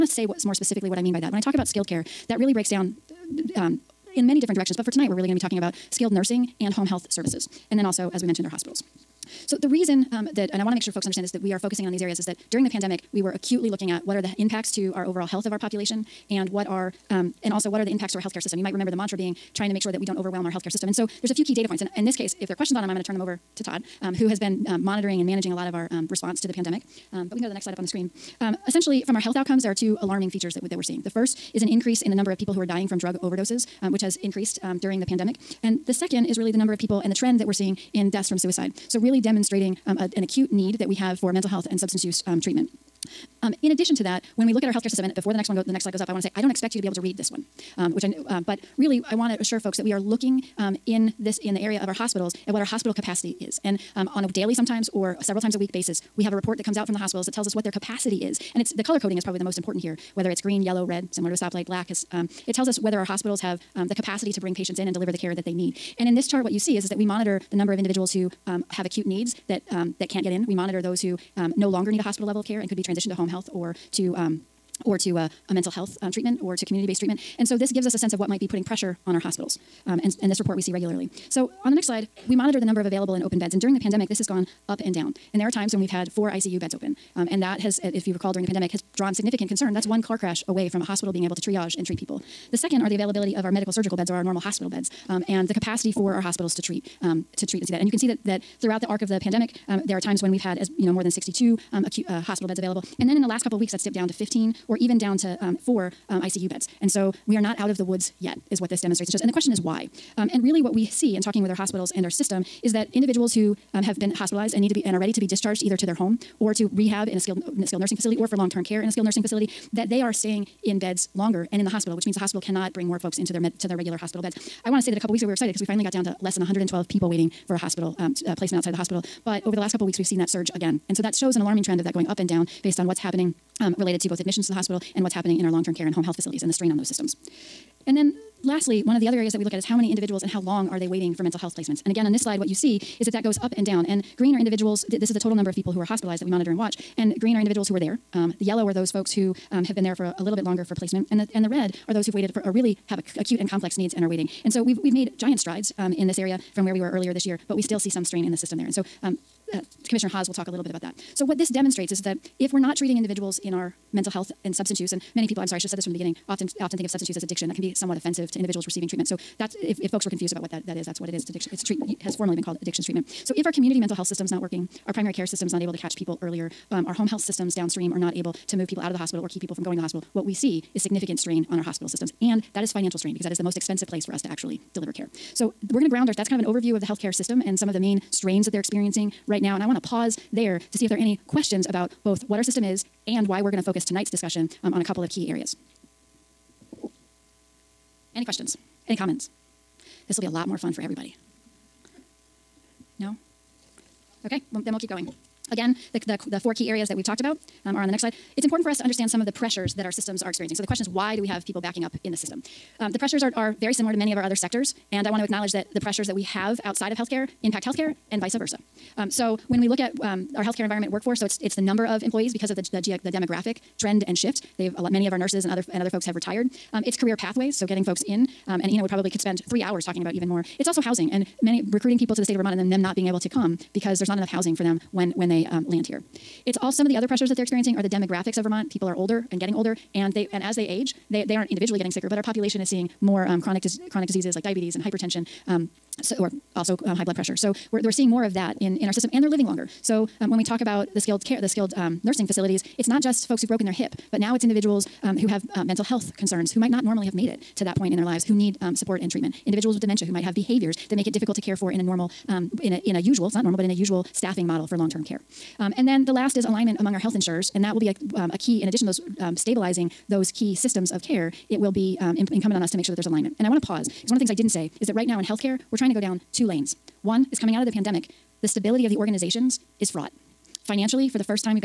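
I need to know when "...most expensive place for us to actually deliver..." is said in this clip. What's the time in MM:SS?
03:03.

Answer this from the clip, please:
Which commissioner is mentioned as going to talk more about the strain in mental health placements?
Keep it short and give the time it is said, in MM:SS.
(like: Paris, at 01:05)
Commissioner Hawes, at 02:39.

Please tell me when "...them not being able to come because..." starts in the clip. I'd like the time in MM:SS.
03:52.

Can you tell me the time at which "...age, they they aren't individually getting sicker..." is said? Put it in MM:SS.
04:00.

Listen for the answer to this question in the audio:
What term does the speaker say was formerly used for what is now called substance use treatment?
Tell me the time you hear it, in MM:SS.
02:52.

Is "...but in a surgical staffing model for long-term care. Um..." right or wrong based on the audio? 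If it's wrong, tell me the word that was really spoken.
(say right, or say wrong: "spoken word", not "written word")
wrong: "usual", not "surgical".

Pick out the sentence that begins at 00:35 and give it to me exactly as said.
And the second is really the number of people and the trend that we're seeing in deaths from suicide.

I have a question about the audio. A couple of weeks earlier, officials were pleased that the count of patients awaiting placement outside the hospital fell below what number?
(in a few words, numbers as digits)
112.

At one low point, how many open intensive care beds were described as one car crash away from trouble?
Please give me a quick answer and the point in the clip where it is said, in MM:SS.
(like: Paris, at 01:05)
4, at 01:26.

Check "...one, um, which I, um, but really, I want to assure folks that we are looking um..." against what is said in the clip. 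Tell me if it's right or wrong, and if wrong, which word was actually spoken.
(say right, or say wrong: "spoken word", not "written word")
right.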